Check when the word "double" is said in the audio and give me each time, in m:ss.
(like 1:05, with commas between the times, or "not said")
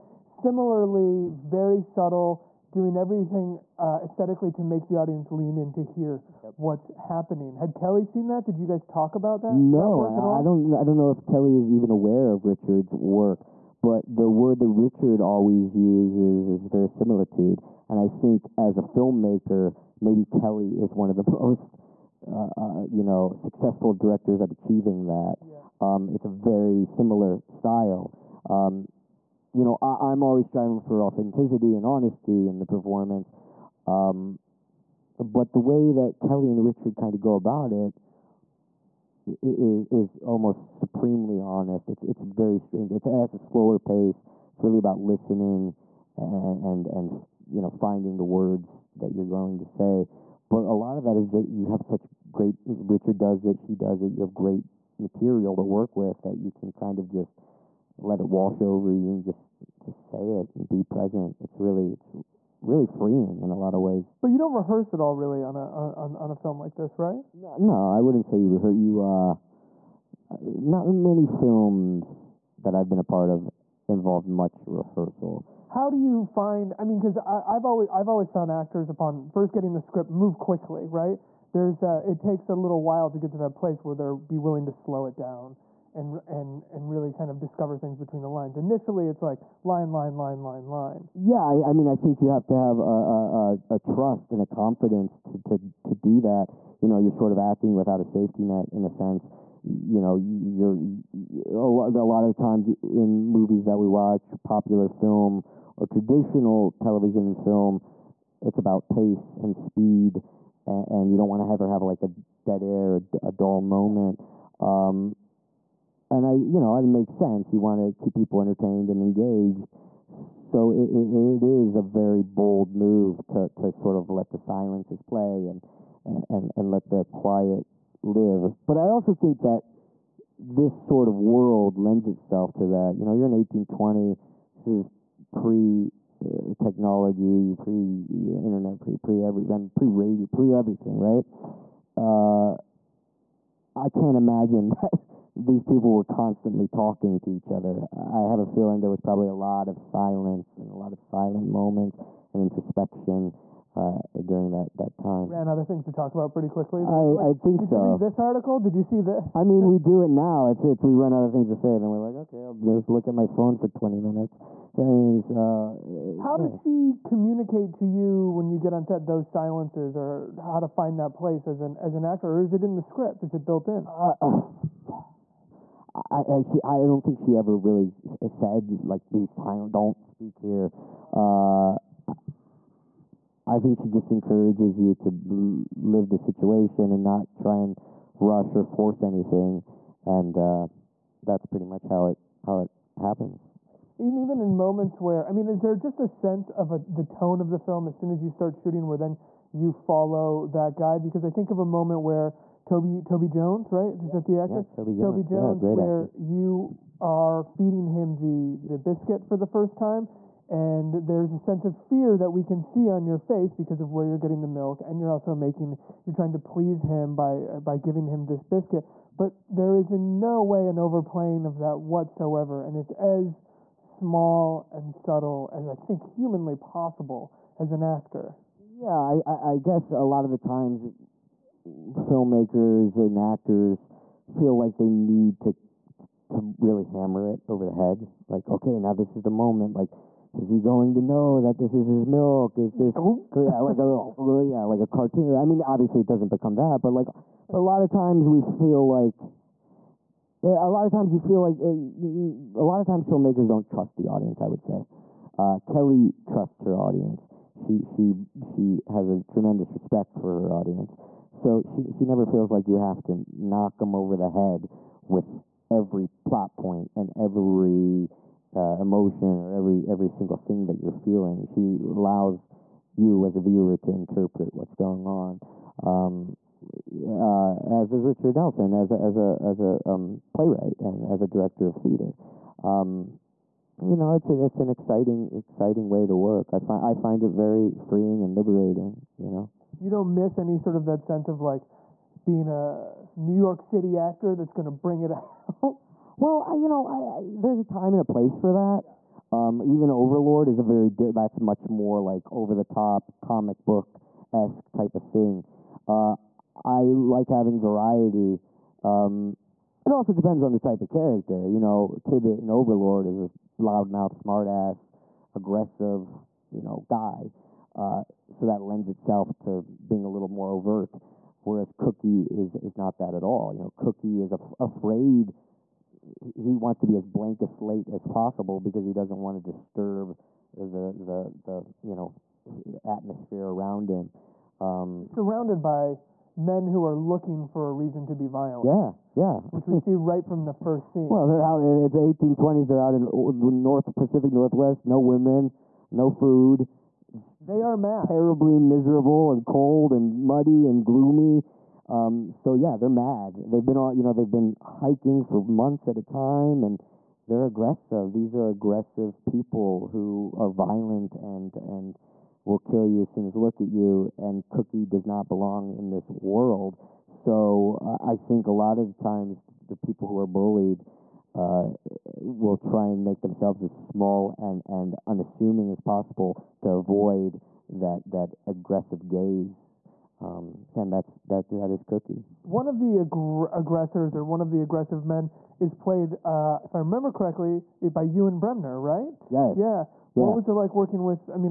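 not said.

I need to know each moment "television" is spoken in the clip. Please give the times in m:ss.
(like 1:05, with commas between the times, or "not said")
1:46.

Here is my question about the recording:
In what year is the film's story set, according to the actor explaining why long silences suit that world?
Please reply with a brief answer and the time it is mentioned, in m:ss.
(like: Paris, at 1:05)
1820, at 2:13.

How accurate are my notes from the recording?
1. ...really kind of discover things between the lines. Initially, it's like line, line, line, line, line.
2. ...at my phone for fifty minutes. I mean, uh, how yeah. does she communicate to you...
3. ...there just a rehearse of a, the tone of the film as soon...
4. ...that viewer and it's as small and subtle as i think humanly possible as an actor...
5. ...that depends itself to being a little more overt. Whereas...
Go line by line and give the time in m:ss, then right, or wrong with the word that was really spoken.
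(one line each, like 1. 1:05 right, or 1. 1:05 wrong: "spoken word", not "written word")
1. 1:26 right
2. 2:43 wrong: "twenty", not "fifty"
3. 3:15 wrong: "sense", not "rehearse"
4. 3:41 wrong: "whatsoever", not "viewer"
5. 5:18 wrong: "lends", not "depends".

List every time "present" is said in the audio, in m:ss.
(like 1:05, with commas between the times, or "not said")
1:00.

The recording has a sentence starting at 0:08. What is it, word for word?
Did you guys talk about that?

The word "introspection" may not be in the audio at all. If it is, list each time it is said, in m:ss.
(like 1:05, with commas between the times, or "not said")
2:32.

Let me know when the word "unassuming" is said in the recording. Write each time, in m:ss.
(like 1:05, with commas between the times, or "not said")
6:15.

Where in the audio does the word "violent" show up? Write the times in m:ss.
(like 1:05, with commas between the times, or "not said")
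5:38, 6:00.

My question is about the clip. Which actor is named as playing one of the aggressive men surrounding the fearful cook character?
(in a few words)
Ewen Bremner.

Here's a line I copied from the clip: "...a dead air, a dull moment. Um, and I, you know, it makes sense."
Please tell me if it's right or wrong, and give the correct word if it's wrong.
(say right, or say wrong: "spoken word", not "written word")
right.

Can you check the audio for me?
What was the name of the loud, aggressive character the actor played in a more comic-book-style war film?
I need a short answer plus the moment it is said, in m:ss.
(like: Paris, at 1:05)
Tibbet, at 5:12.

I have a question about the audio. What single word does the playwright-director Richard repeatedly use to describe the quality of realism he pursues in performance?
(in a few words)
verisimilitude.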